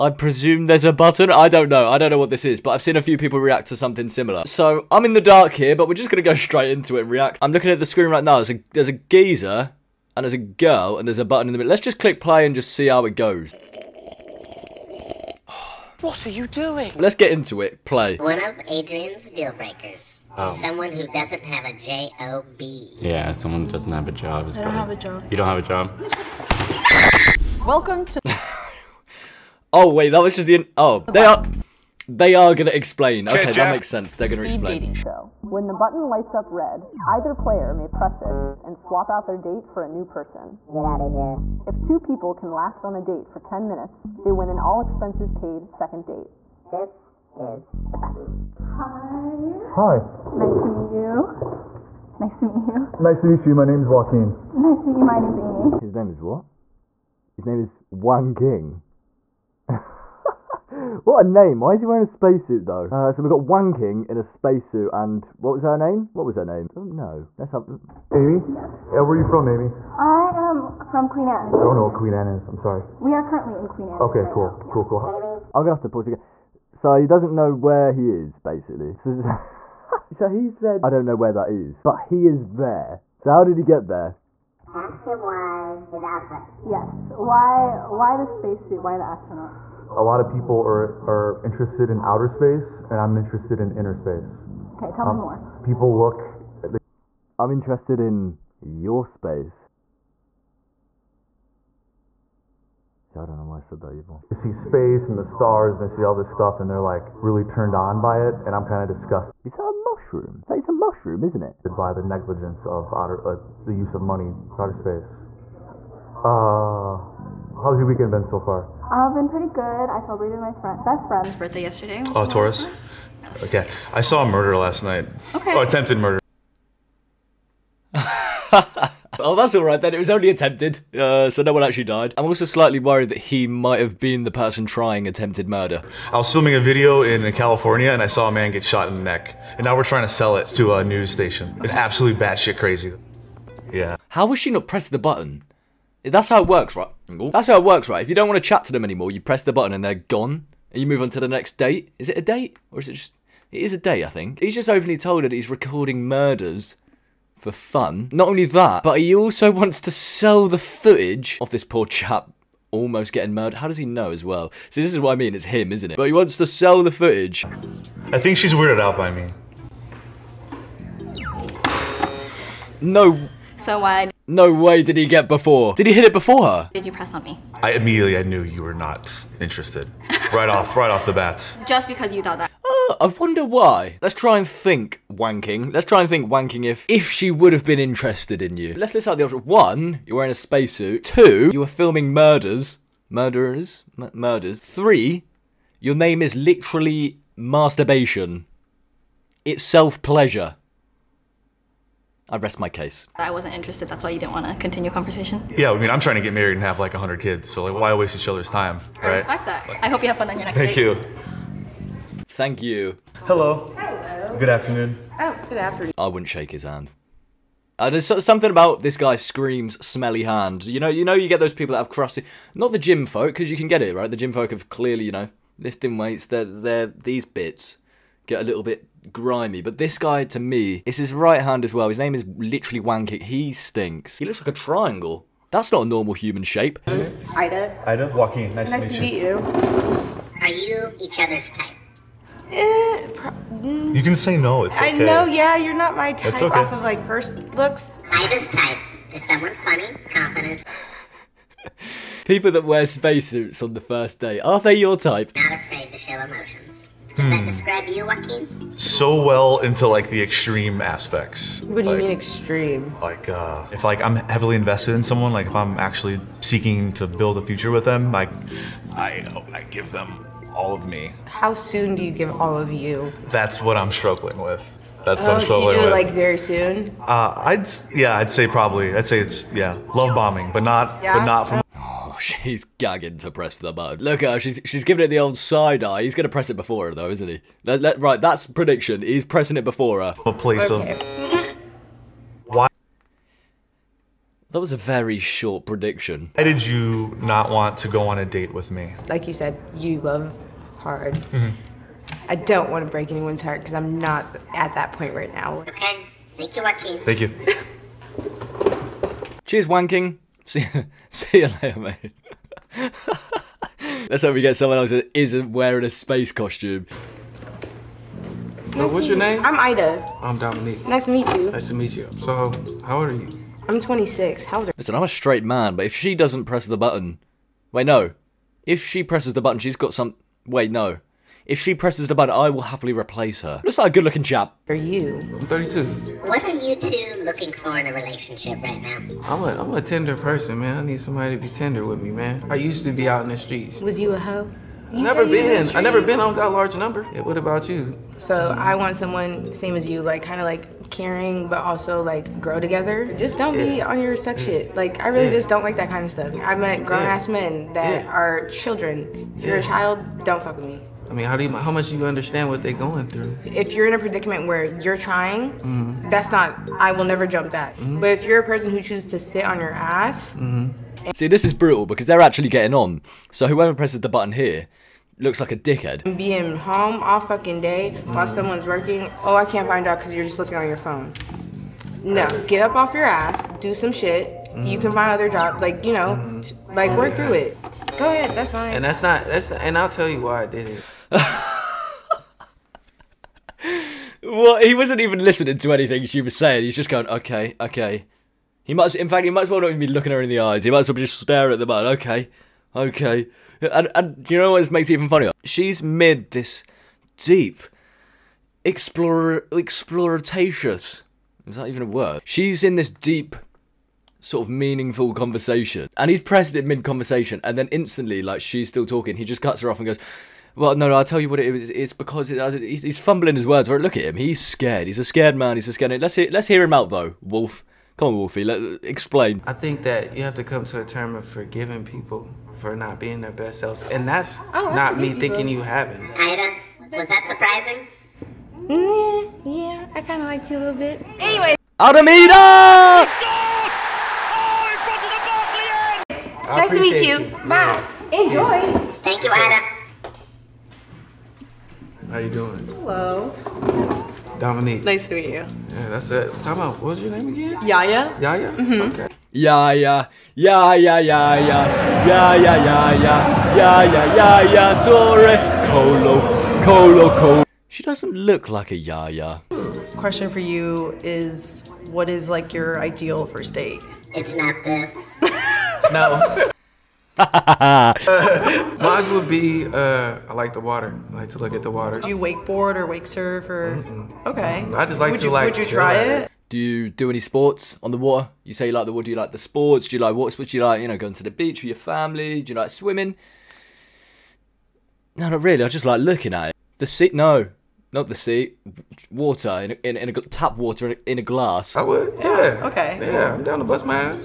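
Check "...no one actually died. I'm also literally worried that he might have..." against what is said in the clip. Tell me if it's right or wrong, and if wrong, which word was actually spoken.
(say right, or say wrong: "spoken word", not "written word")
wrong: "slightly", not "literally".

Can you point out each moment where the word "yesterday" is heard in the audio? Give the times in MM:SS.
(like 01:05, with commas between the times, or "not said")
02:01.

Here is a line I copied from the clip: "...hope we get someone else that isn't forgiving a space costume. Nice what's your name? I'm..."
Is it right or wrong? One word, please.
wrong.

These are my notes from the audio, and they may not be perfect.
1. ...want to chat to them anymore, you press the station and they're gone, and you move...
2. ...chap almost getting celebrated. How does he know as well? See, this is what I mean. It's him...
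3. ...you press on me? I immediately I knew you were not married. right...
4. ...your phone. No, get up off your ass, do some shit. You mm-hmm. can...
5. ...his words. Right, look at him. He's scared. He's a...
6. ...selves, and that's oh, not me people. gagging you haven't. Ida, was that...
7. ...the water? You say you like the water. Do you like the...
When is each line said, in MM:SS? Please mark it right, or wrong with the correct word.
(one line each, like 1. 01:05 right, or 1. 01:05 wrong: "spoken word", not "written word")
1. 02:28 wrong: "button", not "station"
2. 02:41 wrong: "murdered", not "celebrated"
3. 02:56 wrong: "interested", not "married"
4. 06:20 right
5. 07:03 right
6. 07:13 wrong: "thinking", not "gagging"
7. 08:07 right.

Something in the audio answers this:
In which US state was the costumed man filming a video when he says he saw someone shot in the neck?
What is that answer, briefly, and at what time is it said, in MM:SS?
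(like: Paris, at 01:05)
California, at 02:17.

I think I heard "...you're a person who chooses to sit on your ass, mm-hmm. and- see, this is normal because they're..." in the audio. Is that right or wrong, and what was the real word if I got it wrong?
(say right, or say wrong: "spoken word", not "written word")
wrong: "brutal", not "normal".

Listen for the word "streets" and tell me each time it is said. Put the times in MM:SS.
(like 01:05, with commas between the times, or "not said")
05:43.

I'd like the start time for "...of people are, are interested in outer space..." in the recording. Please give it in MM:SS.
01:30.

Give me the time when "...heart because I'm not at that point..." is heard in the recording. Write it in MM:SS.
05:03.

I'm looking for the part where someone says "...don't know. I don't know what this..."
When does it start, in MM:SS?
00:01.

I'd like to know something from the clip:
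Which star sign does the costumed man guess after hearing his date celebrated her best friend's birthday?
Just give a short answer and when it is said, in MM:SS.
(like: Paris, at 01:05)
Taurus, at 02:02.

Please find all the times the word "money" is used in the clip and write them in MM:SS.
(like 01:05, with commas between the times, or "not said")
01:54.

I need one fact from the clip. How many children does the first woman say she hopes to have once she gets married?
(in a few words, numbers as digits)
100.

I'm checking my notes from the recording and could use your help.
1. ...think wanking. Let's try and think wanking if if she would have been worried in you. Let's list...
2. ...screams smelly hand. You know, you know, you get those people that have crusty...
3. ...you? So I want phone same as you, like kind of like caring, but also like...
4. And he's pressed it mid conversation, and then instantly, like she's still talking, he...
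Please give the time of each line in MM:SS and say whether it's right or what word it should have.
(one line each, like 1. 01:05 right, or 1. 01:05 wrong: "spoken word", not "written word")
1. 03:04 wrong: "interested", not "worried"
2. 03:39 right
3. 05:47 wrong: "someone", not "phone"
4. 06:55 right.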